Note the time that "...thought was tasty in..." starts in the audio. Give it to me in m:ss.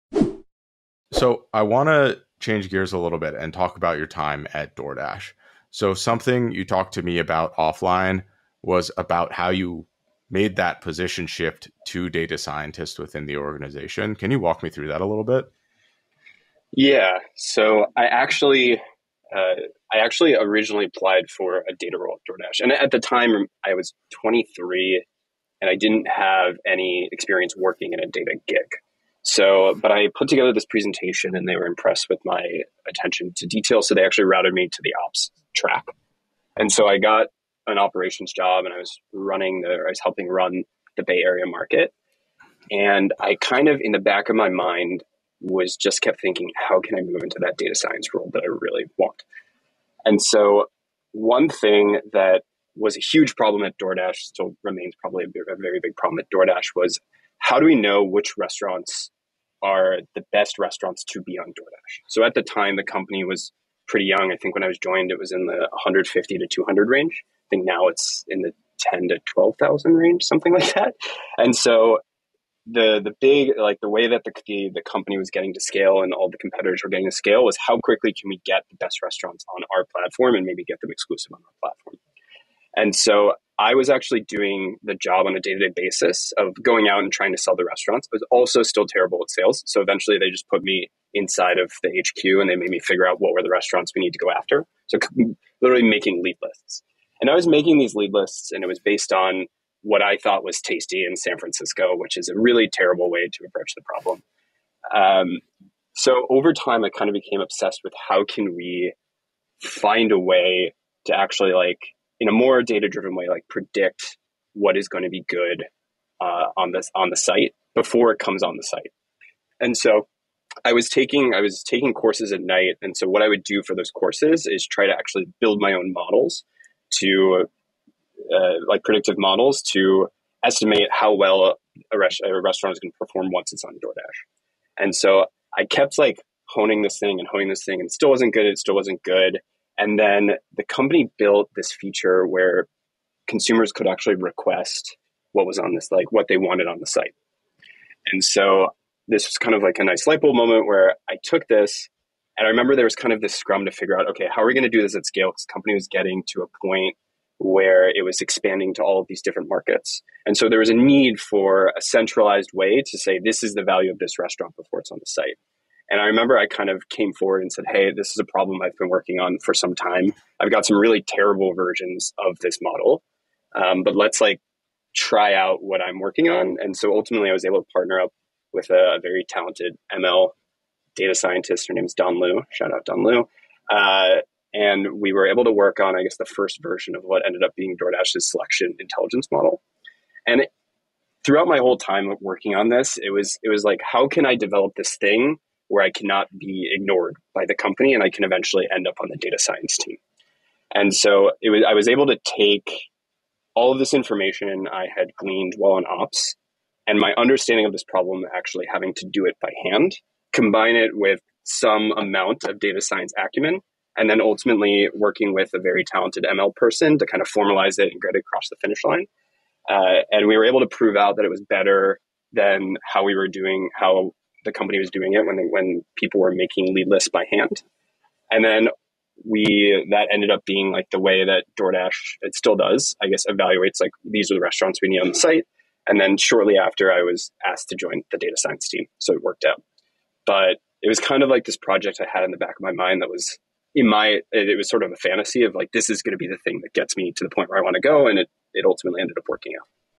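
1:40.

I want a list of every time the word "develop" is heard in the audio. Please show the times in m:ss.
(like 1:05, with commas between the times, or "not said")
3:14.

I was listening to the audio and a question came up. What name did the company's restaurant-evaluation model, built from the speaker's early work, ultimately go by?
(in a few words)
selection intelligence model.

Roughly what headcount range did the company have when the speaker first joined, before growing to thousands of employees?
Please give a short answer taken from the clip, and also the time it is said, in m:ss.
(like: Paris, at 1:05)
150 to 200, at 1:05.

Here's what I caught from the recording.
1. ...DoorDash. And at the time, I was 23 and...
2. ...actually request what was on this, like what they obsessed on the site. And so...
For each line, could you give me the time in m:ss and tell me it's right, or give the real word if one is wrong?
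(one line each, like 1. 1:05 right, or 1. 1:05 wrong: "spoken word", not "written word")
1. 0:22 right
2. 2:23 wrong: "wanted", not "obsessed".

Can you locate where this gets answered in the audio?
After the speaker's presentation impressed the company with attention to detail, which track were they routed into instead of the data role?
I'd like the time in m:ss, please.
0:35.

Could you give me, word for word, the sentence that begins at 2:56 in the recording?
And so ultimately, I was able to partner up with a, very talented ML data scientist.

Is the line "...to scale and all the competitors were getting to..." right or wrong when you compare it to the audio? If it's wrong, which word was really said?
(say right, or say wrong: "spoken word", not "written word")
right.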